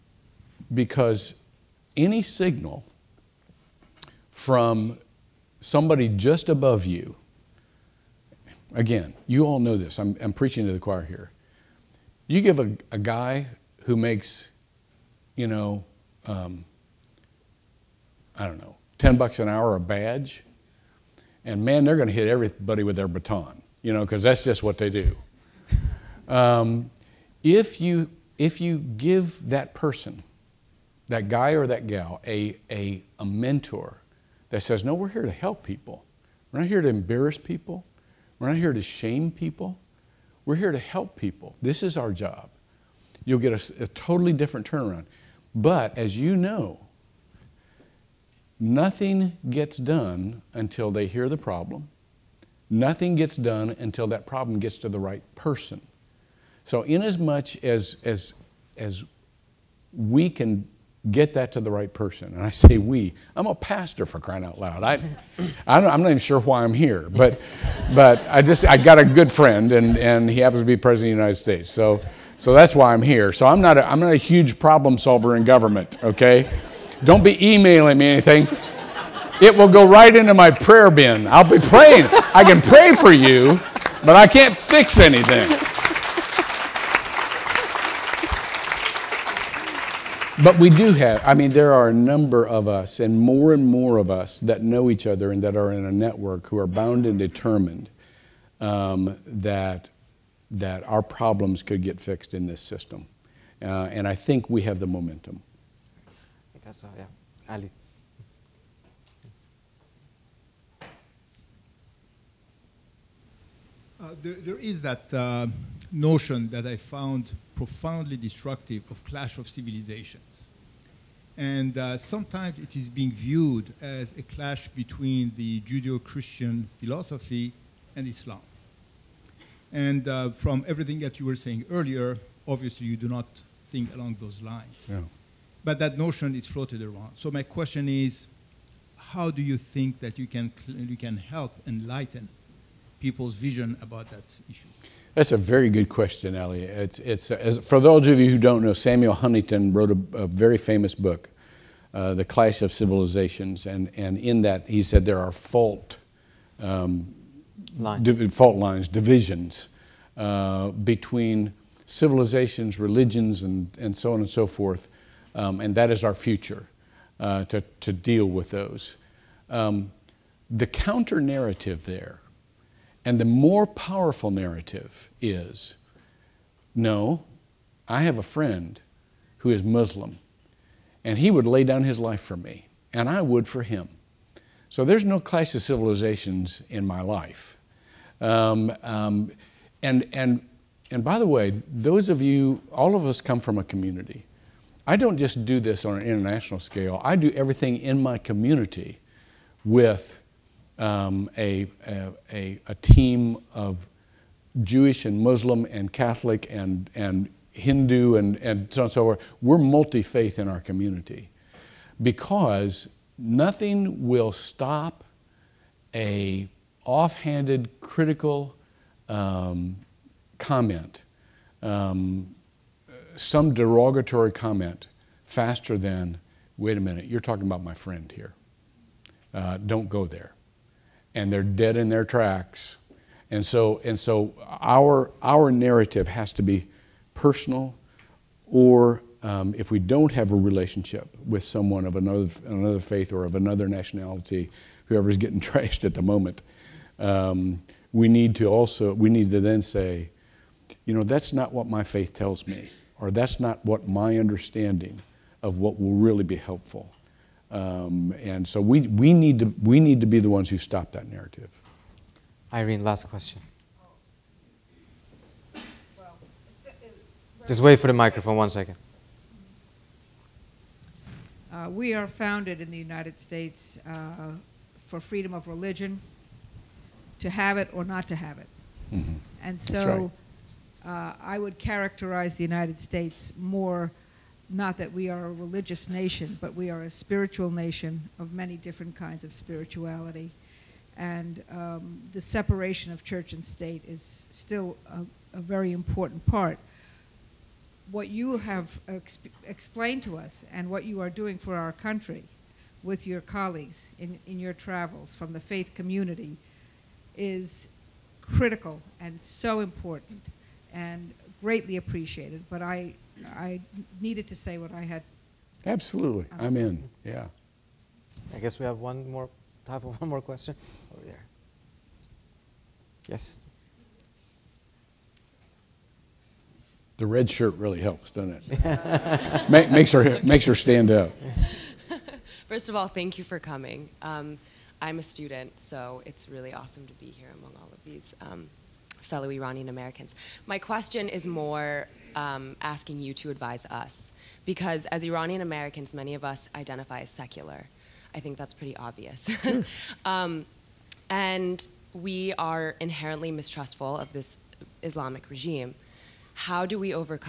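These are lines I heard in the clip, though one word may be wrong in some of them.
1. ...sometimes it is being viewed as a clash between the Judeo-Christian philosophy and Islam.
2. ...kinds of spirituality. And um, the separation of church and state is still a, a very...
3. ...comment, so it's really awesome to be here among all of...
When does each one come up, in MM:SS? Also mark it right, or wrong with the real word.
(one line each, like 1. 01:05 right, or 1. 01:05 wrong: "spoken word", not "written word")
1. 02:01 right
2. 04:48 right
3. 05:35 wrong: "student", not "comment".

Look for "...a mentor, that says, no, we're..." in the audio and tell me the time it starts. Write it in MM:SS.
00:33.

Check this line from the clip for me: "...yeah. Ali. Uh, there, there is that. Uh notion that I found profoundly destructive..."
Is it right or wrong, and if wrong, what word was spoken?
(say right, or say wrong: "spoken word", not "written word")
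right.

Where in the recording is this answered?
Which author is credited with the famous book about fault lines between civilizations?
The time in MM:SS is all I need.
02:28.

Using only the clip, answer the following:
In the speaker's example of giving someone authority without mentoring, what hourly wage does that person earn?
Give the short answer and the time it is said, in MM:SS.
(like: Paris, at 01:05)
$10 an hour, at 00:18.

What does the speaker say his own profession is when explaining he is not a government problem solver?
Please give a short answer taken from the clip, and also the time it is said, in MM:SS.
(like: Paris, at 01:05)
Pastor, at 01:03.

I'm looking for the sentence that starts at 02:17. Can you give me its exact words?
So my question is, how do you think that you can, you can help enlighten people's vision about that issue?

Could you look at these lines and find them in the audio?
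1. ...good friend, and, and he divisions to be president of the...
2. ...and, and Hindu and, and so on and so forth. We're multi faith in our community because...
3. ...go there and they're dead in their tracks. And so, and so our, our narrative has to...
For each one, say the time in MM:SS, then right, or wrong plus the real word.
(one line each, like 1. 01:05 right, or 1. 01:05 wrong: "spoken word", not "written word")
1. 01:09 wrong: "happens", not "divisions"
2. 03:26 right
3. 03:49 right.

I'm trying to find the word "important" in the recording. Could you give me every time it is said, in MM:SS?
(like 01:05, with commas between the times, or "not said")
04:55, 05:09.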